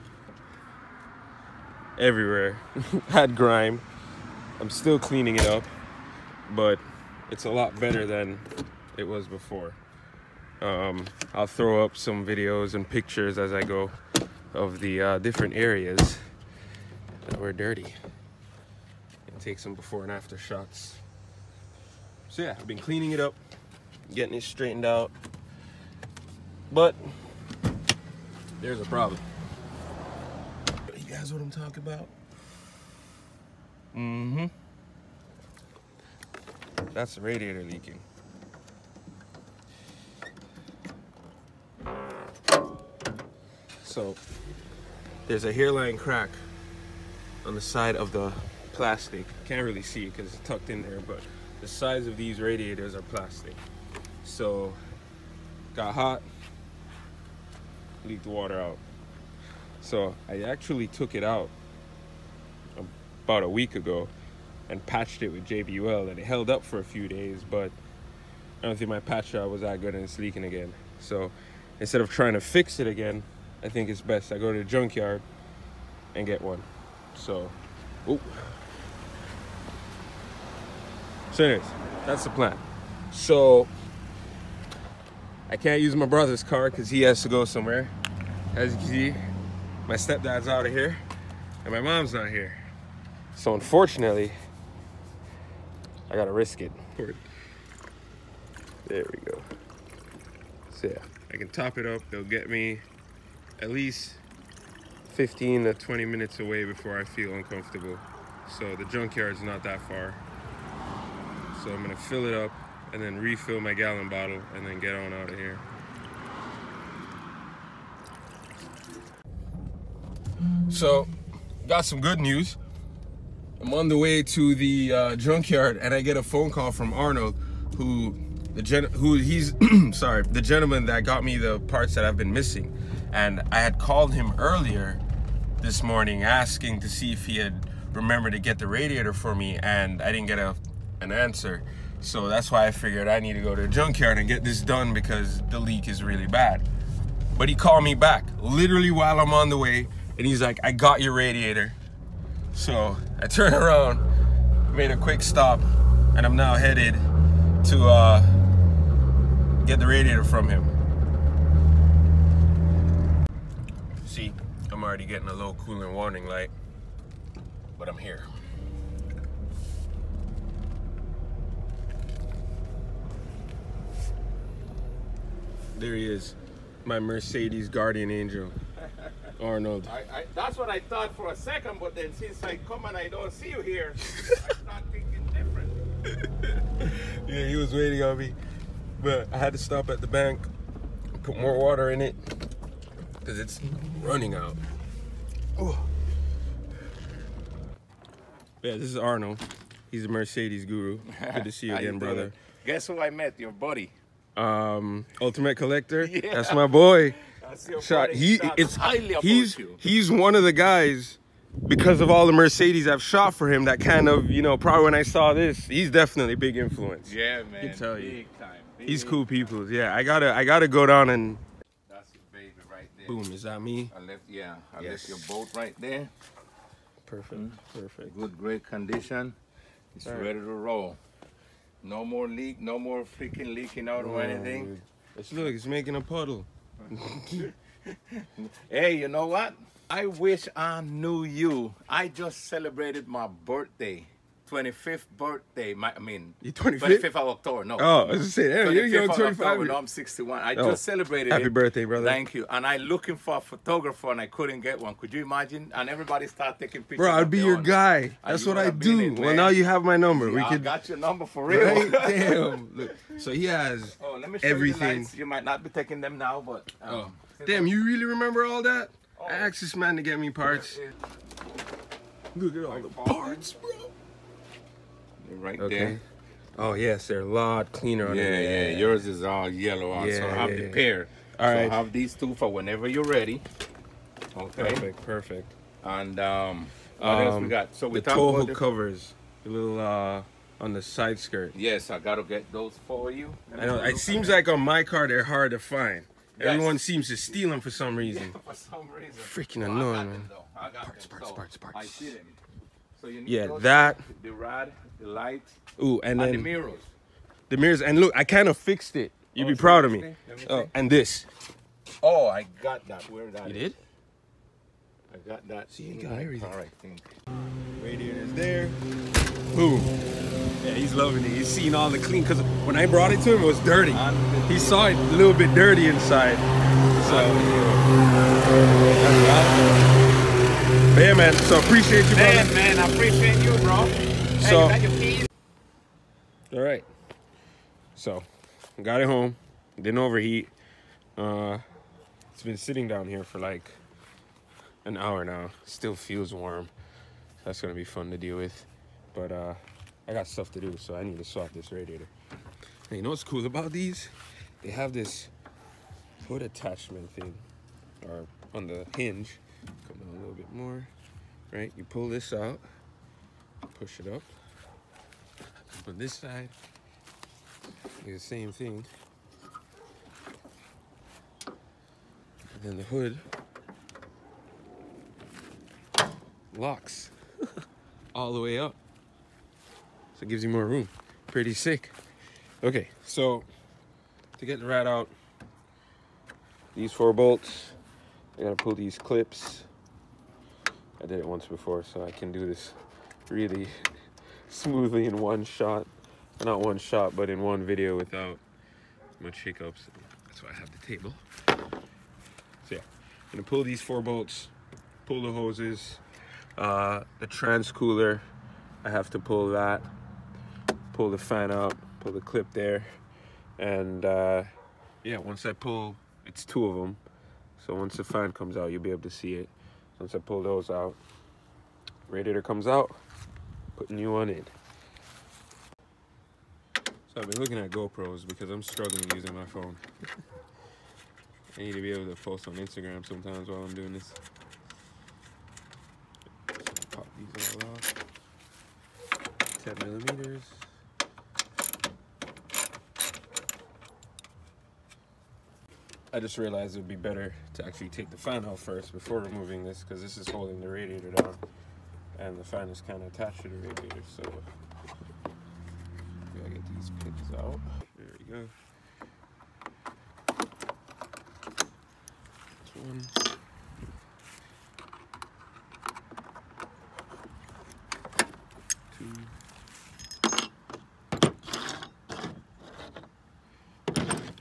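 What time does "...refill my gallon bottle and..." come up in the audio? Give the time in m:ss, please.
1:53.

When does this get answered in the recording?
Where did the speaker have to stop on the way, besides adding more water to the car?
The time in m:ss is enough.
3:09.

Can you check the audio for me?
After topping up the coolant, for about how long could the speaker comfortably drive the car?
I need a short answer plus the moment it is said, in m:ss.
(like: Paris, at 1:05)
15 to 20 minutes, at 1:45.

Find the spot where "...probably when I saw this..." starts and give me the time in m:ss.
3:34.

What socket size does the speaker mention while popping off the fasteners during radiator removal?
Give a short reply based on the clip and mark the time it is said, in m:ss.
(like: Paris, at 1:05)
10 millimeters, at 7:19.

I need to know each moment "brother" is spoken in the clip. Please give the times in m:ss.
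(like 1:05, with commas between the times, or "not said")
1:26, 3:21, 4:11, 5:32.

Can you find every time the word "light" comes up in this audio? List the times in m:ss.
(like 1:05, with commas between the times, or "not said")
2:46, 5:05.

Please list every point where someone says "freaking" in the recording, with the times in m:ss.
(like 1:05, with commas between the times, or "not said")
3:53, 4:59.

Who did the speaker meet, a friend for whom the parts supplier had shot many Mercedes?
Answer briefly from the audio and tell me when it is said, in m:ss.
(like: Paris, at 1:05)
Ultimate Collector, at 3:25.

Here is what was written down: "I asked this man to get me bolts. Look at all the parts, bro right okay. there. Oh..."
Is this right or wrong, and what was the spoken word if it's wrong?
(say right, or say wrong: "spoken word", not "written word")
wrong: "parts", not "bolts".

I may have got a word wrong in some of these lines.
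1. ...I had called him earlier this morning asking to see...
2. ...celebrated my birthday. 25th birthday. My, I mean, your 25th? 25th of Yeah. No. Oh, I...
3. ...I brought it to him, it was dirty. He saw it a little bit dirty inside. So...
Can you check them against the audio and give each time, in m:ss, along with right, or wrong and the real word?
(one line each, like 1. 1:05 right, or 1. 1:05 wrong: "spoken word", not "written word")
1. 2:13 right
2. 4:02 wrong: "October", not "Yeah"
3. 5:22 right.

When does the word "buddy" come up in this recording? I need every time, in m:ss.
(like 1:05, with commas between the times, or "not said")
3:23, 3:28.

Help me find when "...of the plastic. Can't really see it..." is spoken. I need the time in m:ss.
0:47.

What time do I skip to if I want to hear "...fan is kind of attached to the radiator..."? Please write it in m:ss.
7:32.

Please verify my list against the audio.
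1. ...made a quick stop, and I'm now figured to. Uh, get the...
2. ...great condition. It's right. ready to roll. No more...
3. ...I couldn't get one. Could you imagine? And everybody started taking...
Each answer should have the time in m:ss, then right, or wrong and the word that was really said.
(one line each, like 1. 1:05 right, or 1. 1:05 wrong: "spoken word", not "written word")
1. 2:34 wrong: "headed", not "figured"
2. 3:48 right
3. 4:14 right.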